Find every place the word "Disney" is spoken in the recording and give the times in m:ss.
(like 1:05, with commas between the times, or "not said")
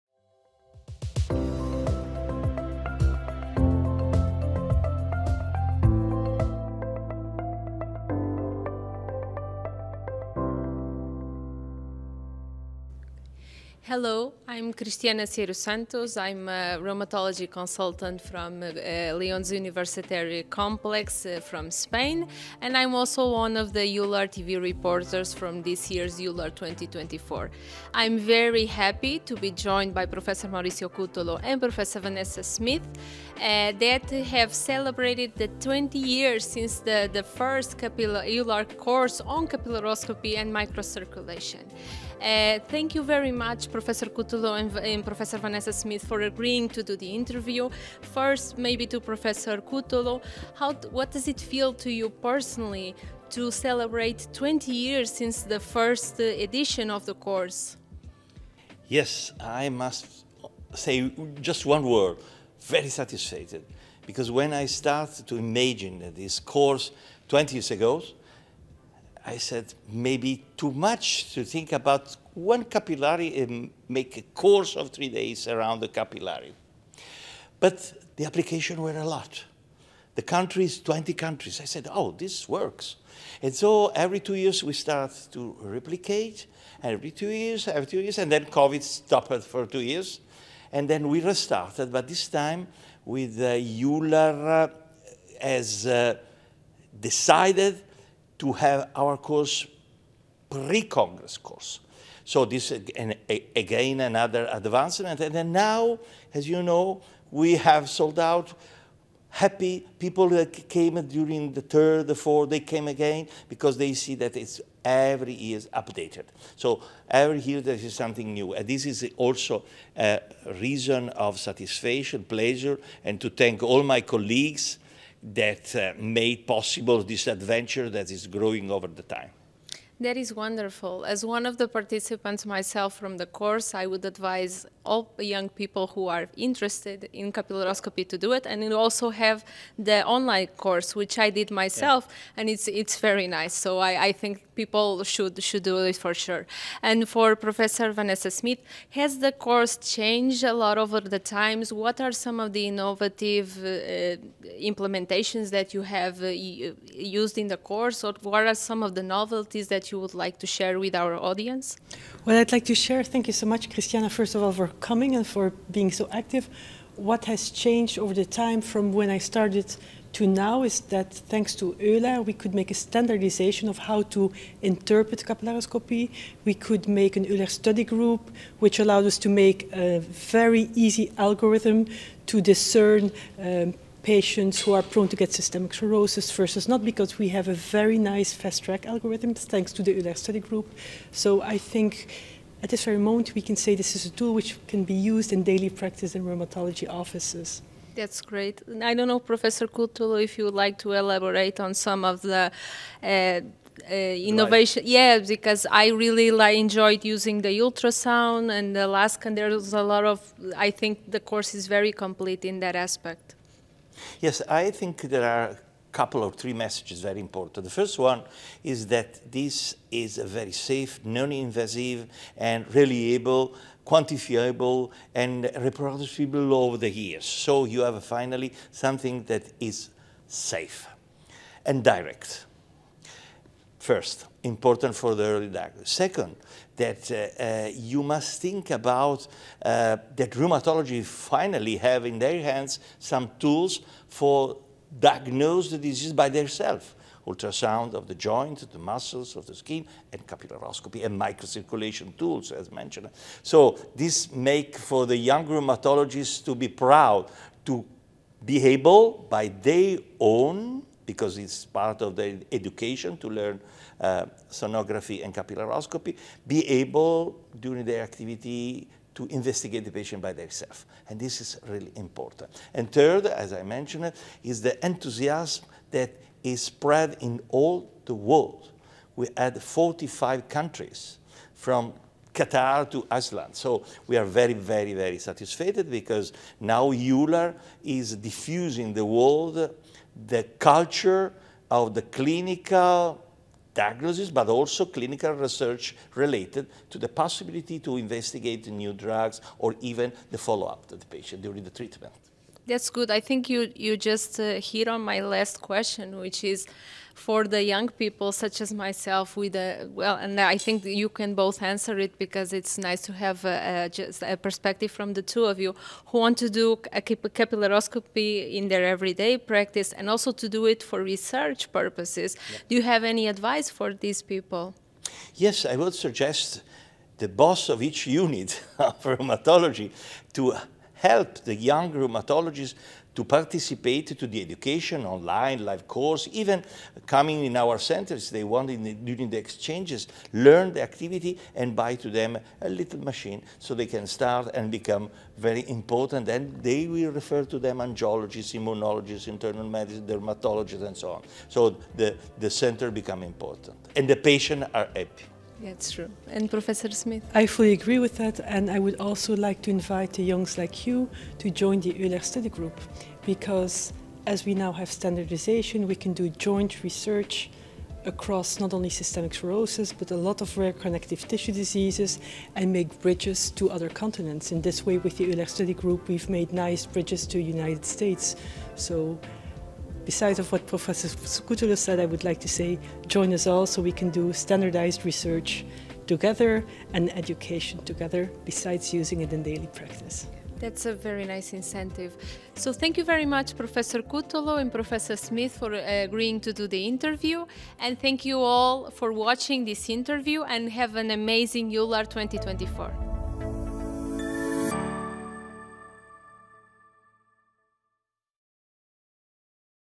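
not said.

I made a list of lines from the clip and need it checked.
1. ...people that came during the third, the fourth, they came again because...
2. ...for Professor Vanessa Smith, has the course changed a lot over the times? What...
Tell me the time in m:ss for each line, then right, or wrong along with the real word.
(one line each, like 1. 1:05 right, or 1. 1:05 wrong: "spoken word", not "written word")
1. 1:49 right
2. 2:27 right.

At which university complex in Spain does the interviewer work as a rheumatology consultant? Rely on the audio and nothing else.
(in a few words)
Leon's University Complex.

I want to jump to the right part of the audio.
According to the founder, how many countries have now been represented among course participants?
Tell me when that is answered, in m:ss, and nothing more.
4:39.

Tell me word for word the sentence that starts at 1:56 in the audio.
So every year there is something new.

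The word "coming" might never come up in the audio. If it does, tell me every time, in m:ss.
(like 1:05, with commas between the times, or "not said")
2:44, 5:37.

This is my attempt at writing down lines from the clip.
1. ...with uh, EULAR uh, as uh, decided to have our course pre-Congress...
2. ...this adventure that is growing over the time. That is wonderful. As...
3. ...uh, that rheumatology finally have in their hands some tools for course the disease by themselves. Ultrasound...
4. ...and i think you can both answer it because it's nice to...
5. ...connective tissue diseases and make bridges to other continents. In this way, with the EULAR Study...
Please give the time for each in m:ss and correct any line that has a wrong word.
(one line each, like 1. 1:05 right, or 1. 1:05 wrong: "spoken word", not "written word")
1. 1:33 right
2. 2:07 right
3. 3:59 wrong: "diagnose", not "course"
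4. 5:10 right
5. 6:10 right.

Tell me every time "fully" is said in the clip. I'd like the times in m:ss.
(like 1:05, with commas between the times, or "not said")
5:57.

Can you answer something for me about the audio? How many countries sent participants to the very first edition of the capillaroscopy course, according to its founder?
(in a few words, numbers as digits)
20.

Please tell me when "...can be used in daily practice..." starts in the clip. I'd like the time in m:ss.
3:14.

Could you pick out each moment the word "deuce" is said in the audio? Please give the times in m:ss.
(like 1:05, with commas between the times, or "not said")
not said.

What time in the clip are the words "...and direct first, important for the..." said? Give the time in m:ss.
3:51.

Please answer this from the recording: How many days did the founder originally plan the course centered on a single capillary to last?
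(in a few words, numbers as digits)
3.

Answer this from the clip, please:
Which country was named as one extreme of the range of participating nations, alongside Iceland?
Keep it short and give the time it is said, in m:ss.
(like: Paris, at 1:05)
Qatar, at 4:42.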